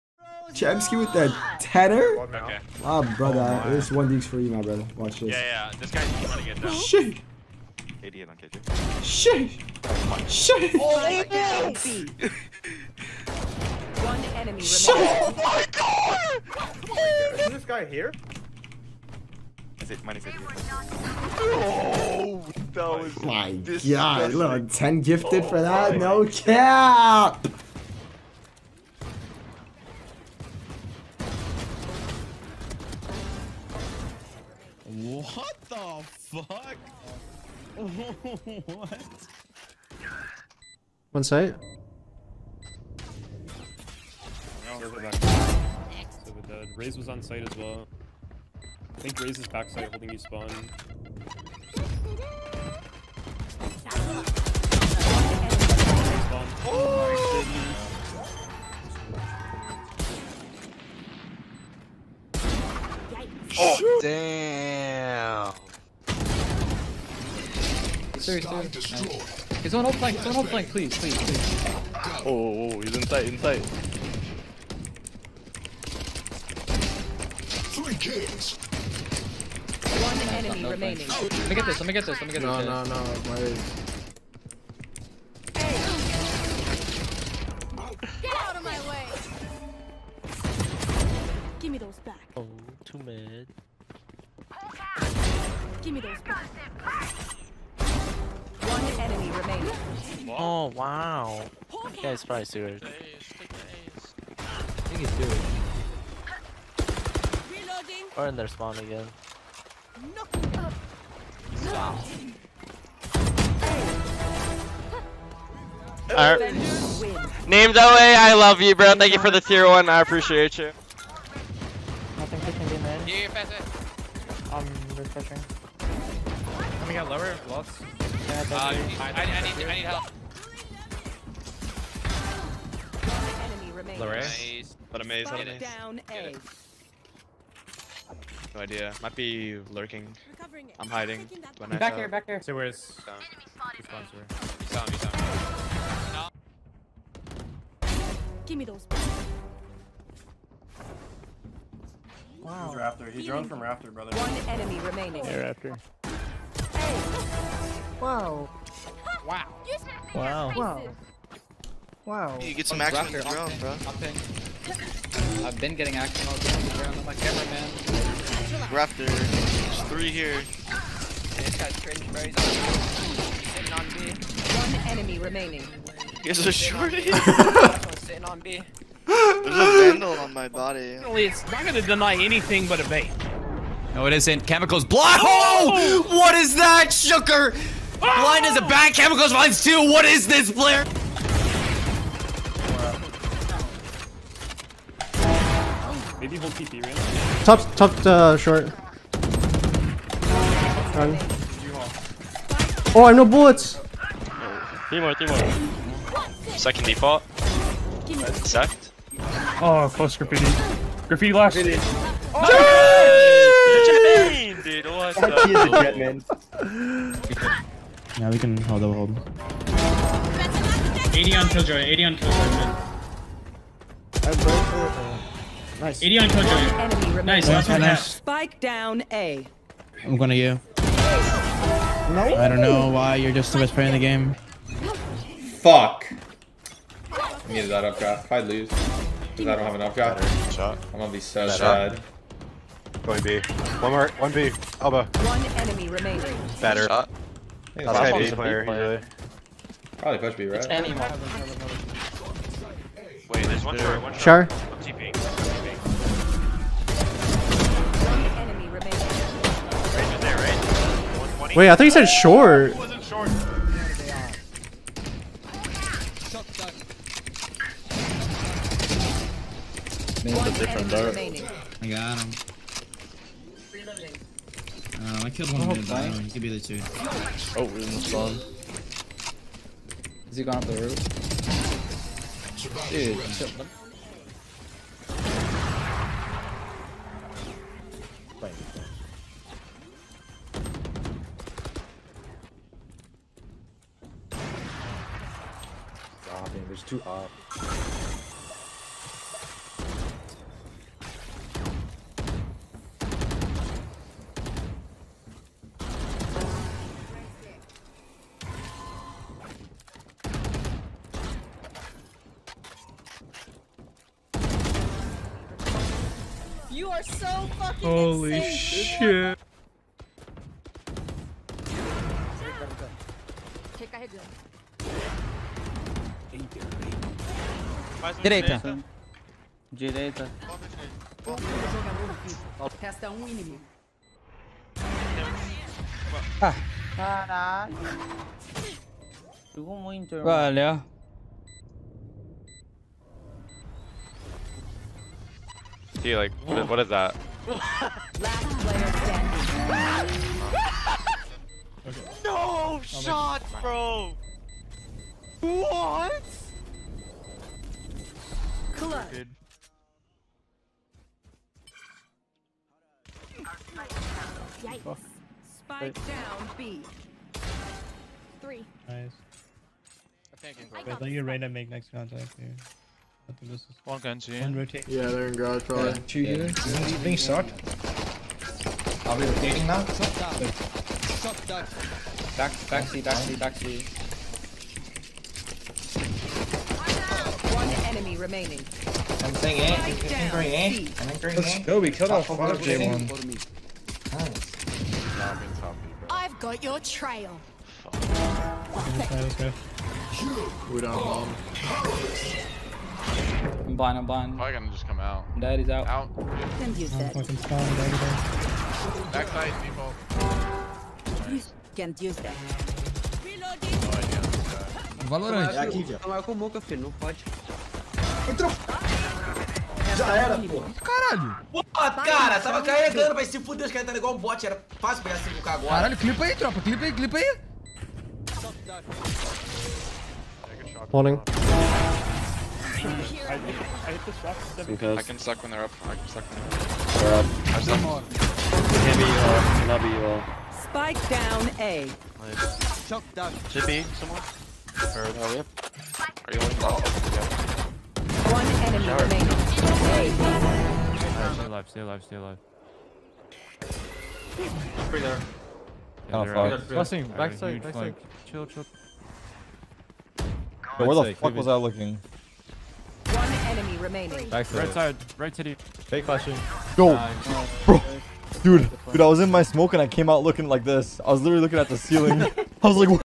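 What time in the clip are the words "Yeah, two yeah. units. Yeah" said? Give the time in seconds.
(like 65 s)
375 s.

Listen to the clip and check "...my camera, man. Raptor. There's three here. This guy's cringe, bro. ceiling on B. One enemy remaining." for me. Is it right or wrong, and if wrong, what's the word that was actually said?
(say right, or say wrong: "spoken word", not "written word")
wrong: "sitting", not "ceiling".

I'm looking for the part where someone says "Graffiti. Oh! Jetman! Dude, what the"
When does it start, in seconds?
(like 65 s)
211 s.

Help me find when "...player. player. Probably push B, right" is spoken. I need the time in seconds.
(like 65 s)
248 s.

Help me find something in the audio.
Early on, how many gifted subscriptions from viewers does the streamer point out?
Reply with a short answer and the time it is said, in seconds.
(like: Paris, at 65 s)
10, at 24 s.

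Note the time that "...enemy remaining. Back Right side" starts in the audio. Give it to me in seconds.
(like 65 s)
463 s.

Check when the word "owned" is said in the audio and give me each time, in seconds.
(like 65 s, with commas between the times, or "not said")
not said.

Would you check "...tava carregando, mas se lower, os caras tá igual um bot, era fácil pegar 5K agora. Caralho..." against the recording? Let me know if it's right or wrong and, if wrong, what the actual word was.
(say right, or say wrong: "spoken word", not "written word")
wrong: "fuder", not "lower".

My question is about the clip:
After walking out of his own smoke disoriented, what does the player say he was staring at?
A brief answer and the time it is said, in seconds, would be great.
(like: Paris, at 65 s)
The ceiling, at 471 s.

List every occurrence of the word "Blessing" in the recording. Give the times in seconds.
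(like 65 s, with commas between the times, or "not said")
456 s.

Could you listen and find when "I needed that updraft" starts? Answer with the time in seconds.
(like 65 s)
237 s.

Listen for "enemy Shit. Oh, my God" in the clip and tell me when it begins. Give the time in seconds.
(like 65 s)
14 s.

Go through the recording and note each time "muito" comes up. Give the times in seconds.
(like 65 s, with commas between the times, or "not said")
339 s.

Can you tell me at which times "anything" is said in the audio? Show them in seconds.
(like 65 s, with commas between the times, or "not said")
182 s.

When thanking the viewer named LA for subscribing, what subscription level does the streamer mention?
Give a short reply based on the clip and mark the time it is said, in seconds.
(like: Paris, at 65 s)
Tier one, at 119 s.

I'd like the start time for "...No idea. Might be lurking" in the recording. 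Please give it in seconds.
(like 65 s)
138 s.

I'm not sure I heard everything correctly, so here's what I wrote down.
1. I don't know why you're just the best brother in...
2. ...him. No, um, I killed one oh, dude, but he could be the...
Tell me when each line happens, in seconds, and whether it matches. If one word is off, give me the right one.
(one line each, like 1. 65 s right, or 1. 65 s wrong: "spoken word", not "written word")
1. 232 s wrong: "player", not "brother"
2. 272 s right.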